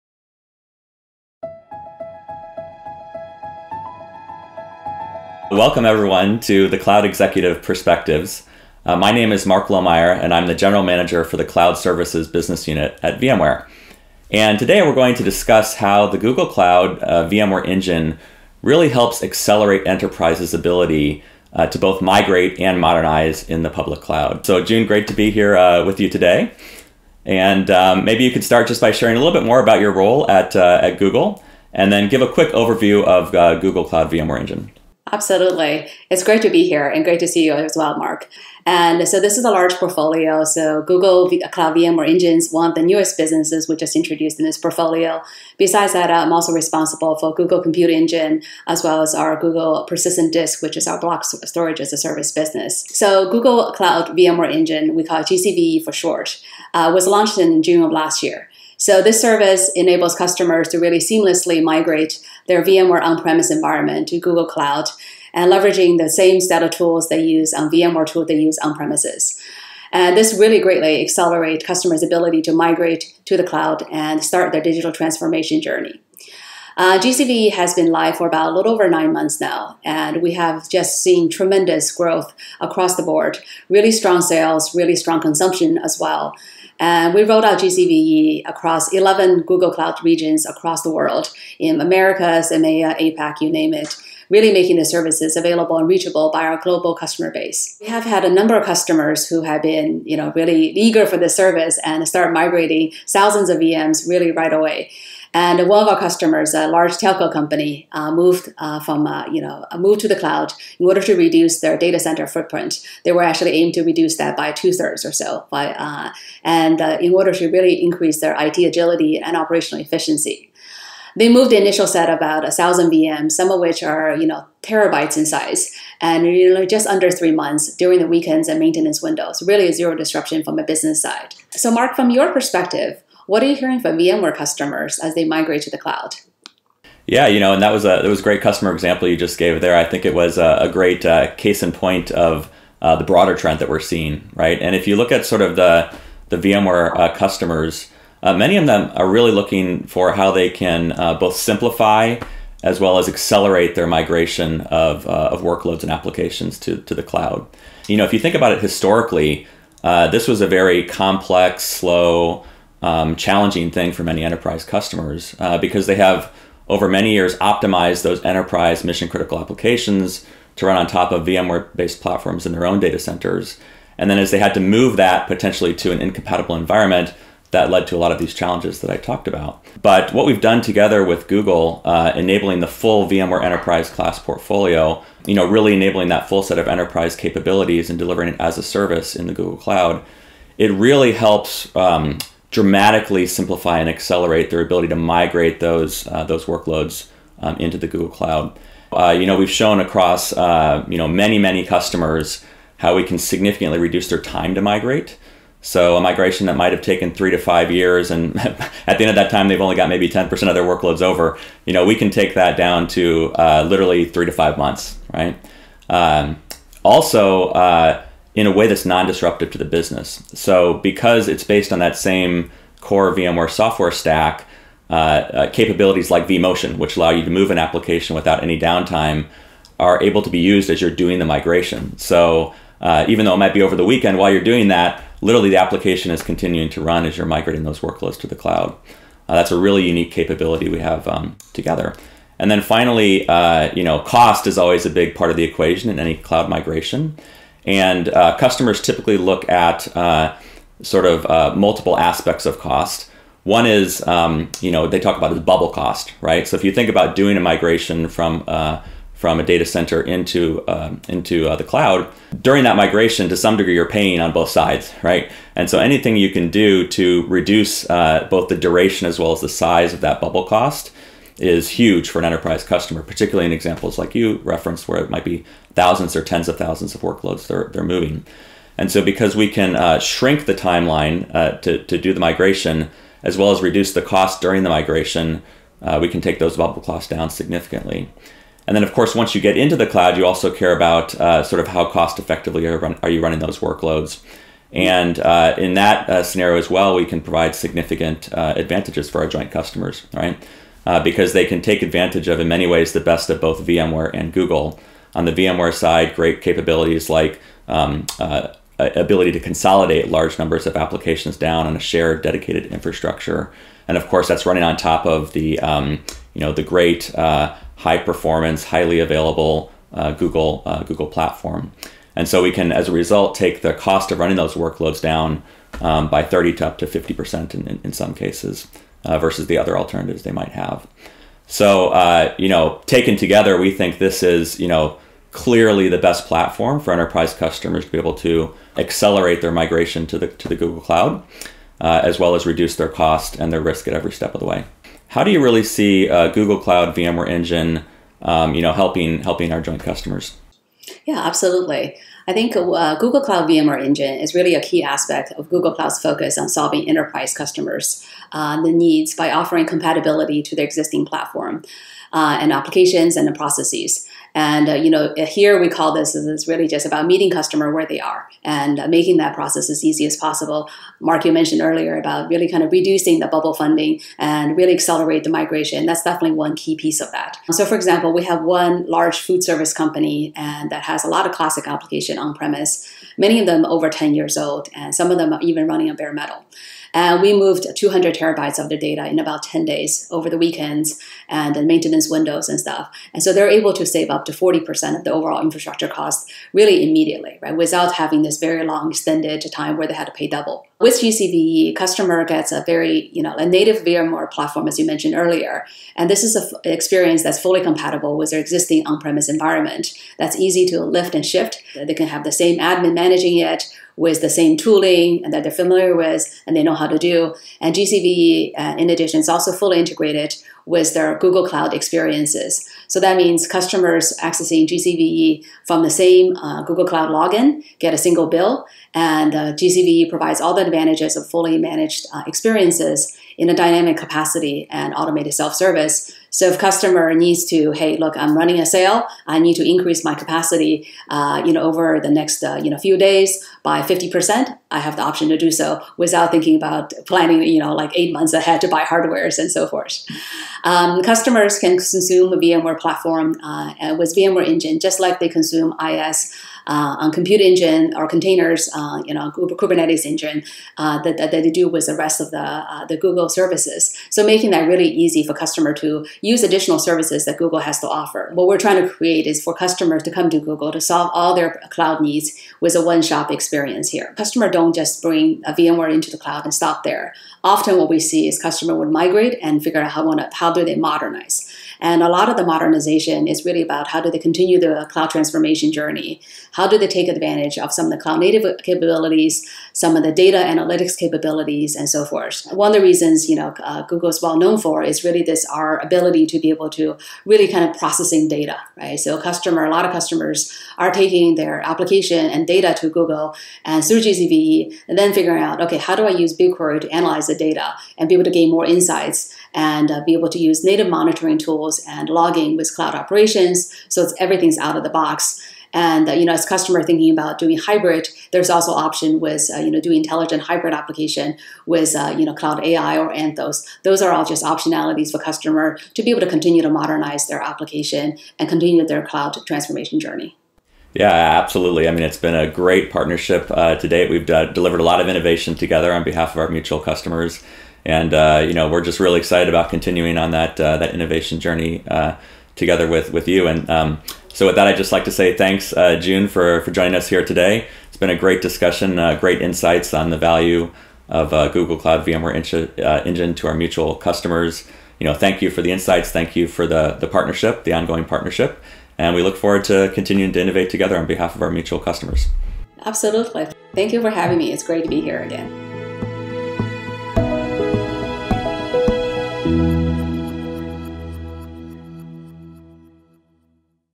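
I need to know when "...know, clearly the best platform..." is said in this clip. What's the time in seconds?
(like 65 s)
334 s.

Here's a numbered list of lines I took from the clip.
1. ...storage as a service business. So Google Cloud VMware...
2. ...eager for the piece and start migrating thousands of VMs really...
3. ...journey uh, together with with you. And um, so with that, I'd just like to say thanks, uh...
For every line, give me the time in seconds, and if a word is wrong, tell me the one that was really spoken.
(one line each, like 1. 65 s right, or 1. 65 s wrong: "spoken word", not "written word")
1. 51 s right
2. 100 s wrong: "service", not "piece"
3. 541 s right.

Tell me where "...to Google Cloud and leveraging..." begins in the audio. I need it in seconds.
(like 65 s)
64 s.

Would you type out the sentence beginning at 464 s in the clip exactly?
So making that really easy for customer to use additional services that Google has to offer.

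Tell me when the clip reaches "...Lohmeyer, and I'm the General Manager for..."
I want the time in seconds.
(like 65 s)
9 s.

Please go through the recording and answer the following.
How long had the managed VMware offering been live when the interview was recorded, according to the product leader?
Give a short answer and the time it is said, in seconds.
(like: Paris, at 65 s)
a little over nine months, at 78 s.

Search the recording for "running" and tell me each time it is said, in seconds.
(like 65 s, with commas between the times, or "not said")
293 s, 314 s, 324 s, 385 s, 438 s.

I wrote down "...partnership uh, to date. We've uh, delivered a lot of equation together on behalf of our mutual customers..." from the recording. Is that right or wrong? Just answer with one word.
wrong.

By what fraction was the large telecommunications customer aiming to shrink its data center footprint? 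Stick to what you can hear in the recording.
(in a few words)
two thirds.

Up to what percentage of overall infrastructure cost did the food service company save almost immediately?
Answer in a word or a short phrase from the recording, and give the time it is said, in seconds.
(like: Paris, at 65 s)
40%, at 394 s.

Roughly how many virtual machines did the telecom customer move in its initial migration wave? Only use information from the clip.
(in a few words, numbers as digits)
about a thousand.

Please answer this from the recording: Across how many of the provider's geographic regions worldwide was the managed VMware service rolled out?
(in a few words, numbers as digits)
11.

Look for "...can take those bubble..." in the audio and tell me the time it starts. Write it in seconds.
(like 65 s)
286 s.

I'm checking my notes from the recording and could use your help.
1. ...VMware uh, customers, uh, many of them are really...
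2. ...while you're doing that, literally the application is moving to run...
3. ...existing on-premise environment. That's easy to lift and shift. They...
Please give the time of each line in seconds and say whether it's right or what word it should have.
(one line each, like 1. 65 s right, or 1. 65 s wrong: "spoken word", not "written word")
1. 146 s right
2. 234 s wrong: "continuing", not "moving"
3. 408 s right.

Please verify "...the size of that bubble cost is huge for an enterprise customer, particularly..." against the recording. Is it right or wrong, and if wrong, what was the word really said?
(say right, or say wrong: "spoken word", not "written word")
right.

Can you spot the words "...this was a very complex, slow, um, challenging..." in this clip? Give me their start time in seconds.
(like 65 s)
159 s.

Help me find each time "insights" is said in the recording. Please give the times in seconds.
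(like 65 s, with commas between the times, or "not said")
508 s, 549 s, 555 s.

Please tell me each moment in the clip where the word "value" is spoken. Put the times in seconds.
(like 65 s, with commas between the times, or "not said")
550 s.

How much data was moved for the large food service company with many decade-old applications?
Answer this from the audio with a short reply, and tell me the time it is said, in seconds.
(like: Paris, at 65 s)
200 terabytes, at 387 s.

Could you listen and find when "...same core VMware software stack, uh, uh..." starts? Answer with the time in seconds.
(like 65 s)
221 s.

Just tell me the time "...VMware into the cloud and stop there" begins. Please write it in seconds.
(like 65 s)
475 s.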